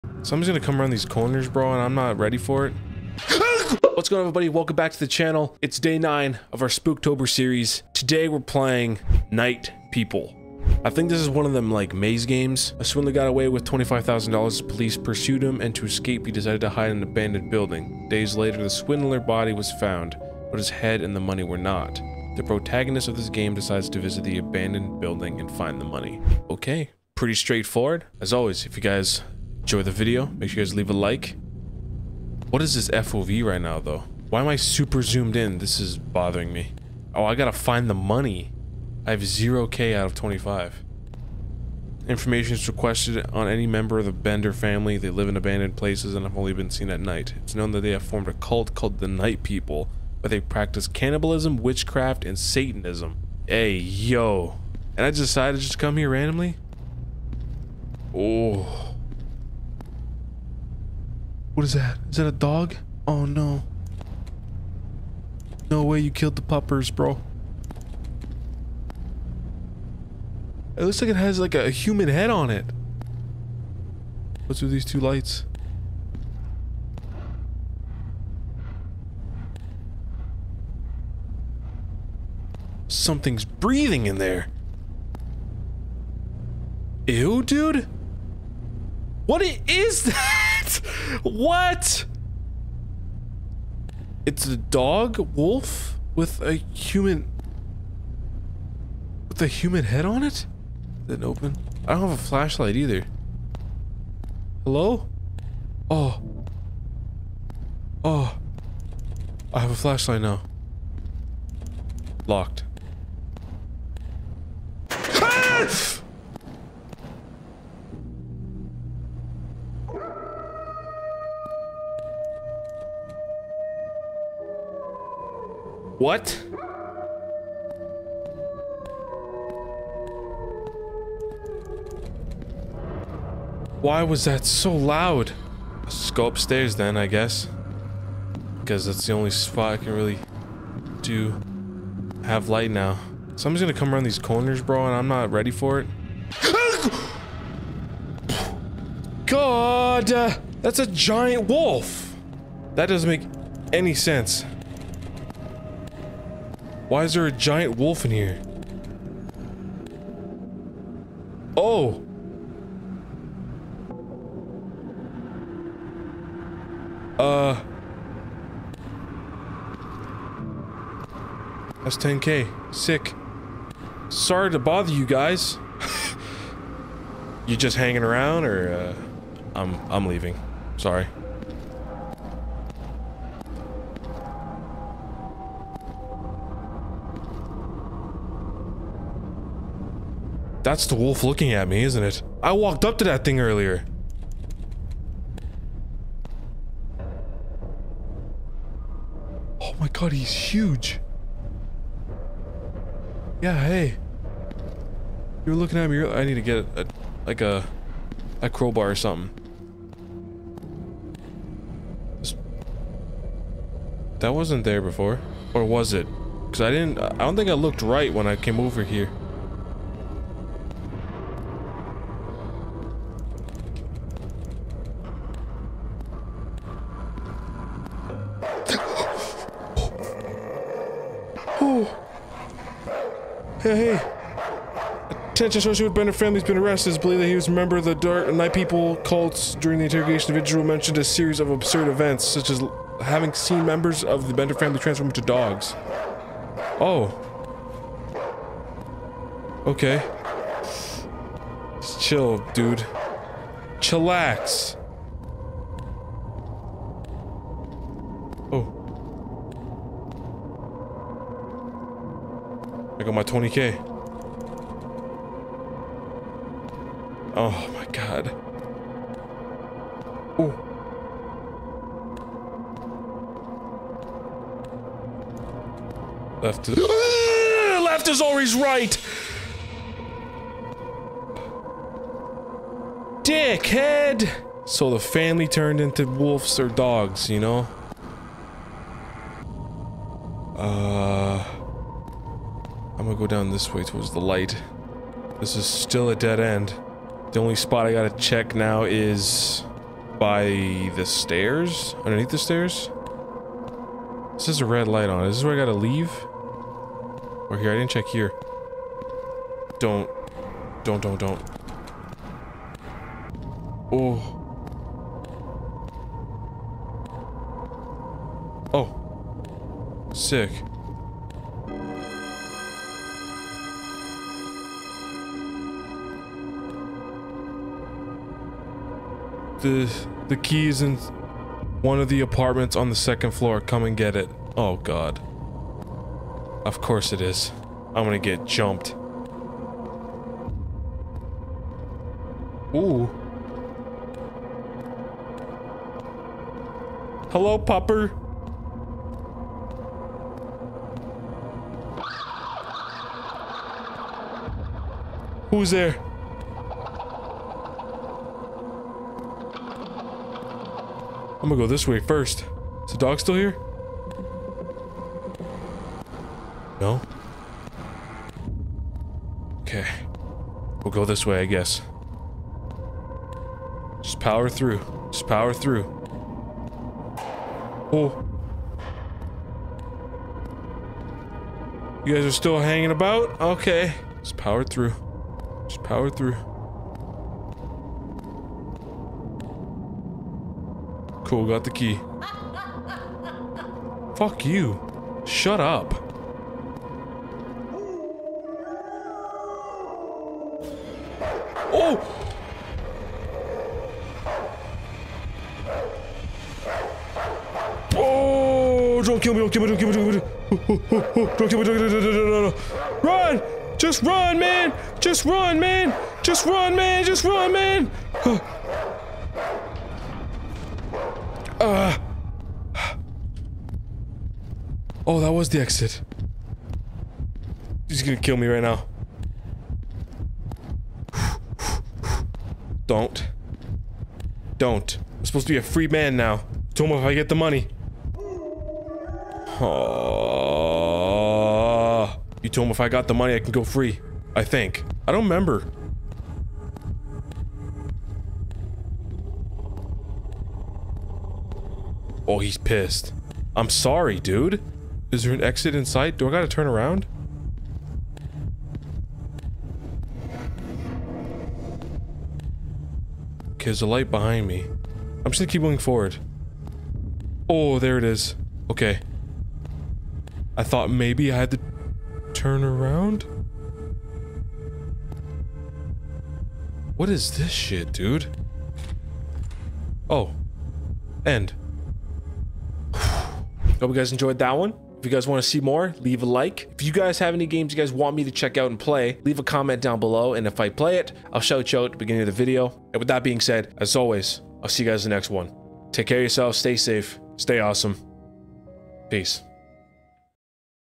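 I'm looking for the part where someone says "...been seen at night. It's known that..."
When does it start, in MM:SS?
00:46.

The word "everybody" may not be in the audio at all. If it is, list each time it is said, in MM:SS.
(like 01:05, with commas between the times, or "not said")
00:04.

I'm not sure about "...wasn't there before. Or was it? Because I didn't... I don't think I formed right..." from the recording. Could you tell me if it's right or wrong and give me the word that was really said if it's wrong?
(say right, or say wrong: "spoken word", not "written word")
wrong: "looked", not "formed".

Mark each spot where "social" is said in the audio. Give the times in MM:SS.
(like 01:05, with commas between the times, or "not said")
03:55.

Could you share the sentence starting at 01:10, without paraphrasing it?
It looks like it has like a human head on it.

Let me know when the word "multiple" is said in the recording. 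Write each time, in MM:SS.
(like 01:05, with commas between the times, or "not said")
not said.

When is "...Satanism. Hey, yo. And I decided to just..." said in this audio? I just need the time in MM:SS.
00:52.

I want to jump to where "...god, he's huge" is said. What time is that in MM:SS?
03:19.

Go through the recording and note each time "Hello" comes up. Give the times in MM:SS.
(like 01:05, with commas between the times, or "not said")
01:44, 05:47.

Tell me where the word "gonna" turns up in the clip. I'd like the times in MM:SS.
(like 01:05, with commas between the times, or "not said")
00:00, 02:23, 05:38, 06:01, 07:08, 07:45.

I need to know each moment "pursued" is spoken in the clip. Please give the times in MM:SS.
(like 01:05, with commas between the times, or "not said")
00:14.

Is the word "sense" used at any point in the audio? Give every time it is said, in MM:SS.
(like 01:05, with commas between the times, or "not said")
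02:33.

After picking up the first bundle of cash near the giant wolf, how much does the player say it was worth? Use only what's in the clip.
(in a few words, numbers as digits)
10k.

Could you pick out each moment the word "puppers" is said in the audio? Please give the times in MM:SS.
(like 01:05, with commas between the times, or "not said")
01:06, 05:47.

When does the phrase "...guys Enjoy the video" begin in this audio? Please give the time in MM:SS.
00:28.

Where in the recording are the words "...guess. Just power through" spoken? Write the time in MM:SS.
06:11.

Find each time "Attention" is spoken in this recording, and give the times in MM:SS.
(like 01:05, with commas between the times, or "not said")
03:55.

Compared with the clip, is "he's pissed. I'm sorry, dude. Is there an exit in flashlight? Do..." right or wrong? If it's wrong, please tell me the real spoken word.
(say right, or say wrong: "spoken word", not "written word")
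wrong: "sight", not "flashlight".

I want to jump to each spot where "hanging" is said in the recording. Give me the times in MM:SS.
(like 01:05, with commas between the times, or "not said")
02:57, 06:22.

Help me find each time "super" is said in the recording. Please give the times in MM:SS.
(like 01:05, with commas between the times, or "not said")
00:34.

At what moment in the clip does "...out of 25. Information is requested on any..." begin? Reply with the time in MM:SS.
00:39.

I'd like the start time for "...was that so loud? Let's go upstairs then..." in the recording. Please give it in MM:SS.
02:14.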